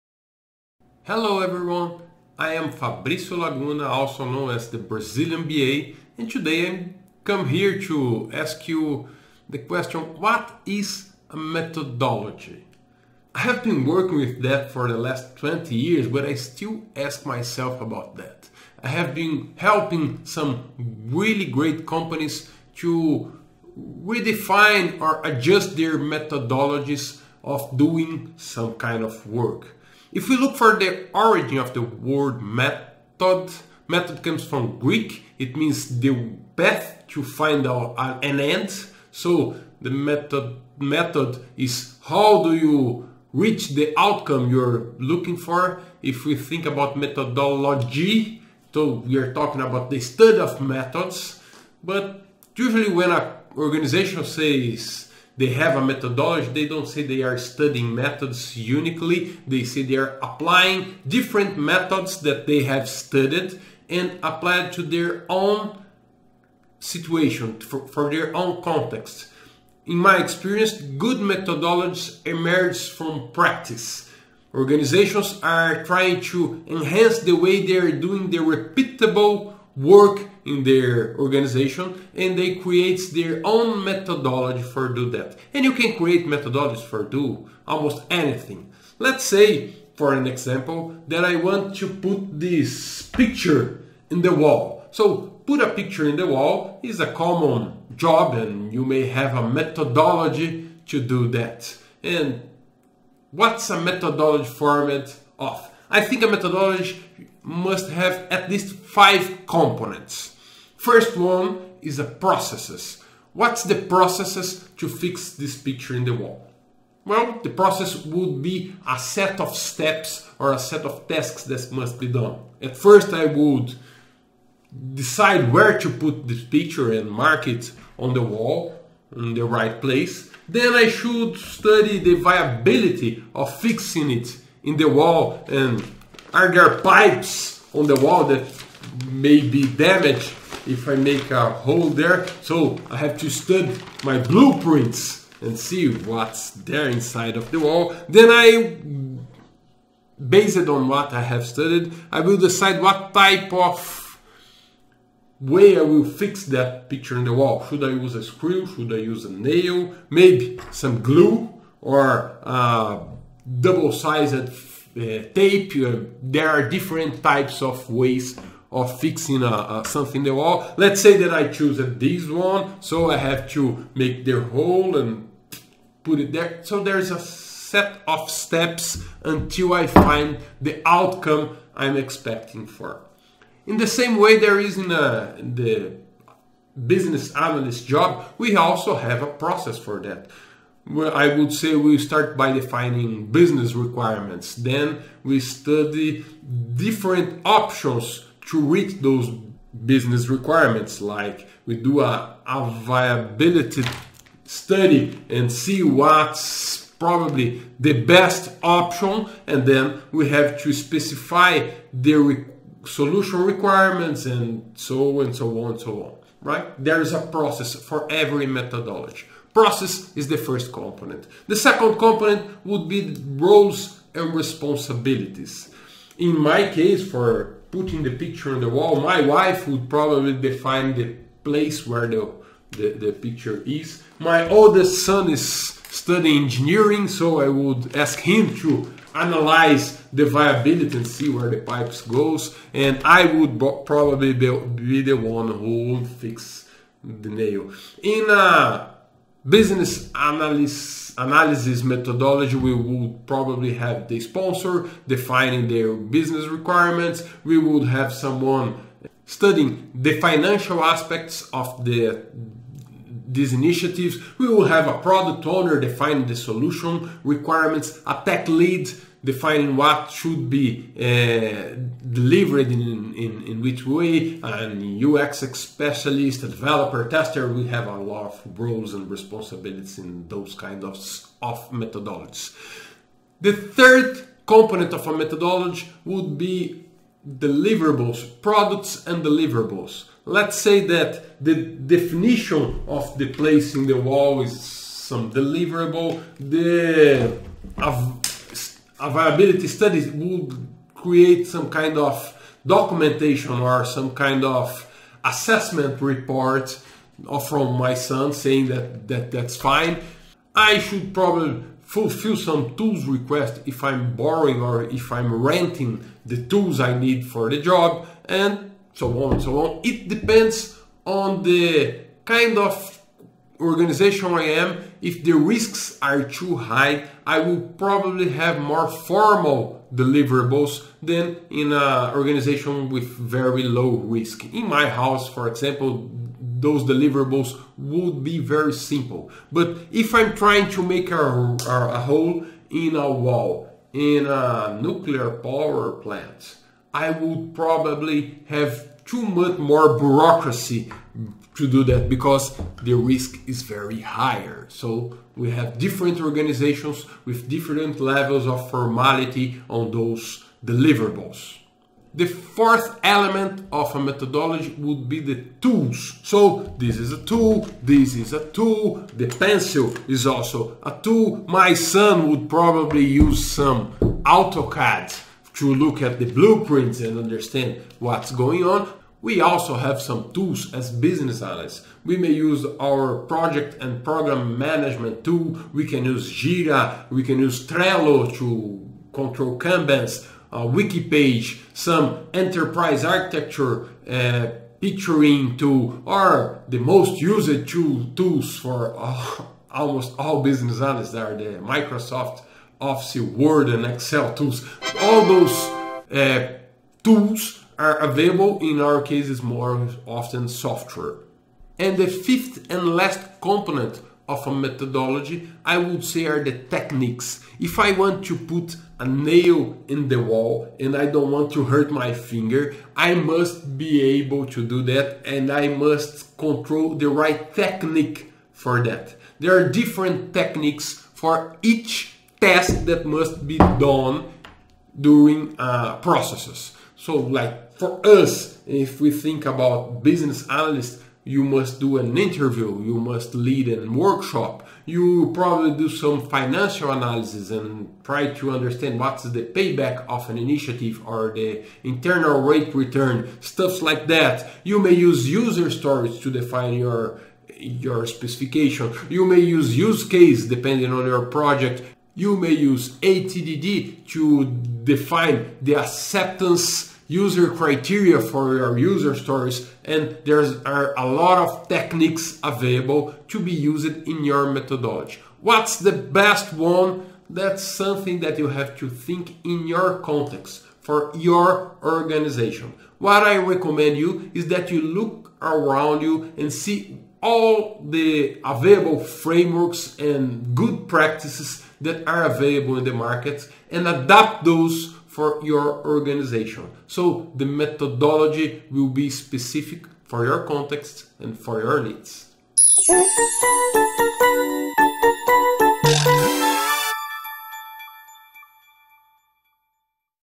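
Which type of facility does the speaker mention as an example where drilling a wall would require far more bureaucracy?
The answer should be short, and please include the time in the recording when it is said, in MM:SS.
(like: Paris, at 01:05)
nuclear power plant, at 05:44.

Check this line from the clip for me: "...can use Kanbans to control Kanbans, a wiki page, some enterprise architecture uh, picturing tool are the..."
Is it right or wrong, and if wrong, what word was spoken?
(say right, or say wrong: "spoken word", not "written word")
wrong: "Trello", not "Kanbans".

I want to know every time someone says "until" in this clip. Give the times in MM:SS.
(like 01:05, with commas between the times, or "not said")
02:59.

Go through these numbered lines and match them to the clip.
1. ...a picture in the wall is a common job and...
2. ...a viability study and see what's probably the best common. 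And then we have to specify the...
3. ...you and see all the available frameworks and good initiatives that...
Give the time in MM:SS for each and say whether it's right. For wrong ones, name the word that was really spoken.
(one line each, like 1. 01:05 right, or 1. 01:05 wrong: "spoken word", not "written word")
1. 01:35 right
2. 03:22 wrong: "option", not "common"
3. 08:06 wrong: "practices", not "initiatives".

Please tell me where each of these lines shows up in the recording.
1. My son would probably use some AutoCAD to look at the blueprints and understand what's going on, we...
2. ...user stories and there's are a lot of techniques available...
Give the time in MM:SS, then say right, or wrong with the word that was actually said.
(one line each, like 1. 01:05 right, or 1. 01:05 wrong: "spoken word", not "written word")
1. 06:11 right
2. 07:48 right.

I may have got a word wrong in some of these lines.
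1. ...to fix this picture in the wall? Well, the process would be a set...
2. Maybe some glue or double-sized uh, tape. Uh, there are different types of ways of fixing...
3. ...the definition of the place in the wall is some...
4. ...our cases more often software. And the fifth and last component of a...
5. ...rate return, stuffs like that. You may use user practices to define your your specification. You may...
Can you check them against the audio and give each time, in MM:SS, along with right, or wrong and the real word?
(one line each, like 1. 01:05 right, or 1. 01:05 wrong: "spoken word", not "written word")
1. 01:54 right
2. 02:40 right
3. 04:51 right
4. 06:48 right
5. 07:32 wrong: "stories", not "practices".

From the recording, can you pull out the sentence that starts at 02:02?
At first I would decide where to put this picture and mark it on the wall in the right place.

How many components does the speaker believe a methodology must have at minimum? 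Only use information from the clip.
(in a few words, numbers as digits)
5.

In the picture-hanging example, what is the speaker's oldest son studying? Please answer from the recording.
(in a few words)
engineering.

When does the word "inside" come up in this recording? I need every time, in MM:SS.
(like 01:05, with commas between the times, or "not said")
02:26.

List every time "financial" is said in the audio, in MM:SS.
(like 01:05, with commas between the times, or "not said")
04:20, 07:26.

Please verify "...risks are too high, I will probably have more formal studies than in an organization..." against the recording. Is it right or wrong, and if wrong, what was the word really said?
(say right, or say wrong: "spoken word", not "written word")
wrong: "deliverables", not "studies".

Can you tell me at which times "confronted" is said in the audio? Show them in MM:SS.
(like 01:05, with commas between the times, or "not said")
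not said.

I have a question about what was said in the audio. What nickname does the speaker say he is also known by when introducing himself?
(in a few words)
the Brazilian BA.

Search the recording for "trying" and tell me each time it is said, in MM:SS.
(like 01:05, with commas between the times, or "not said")
01:15, 05:40.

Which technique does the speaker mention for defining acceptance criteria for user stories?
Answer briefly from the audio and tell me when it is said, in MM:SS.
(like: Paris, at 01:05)
ATDD, at 07:42.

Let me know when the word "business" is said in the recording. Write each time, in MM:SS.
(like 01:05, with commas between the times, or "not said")
03:06, 03:13, 03:19, 04:09, 04:15, 06:20, 06:40, 07:20.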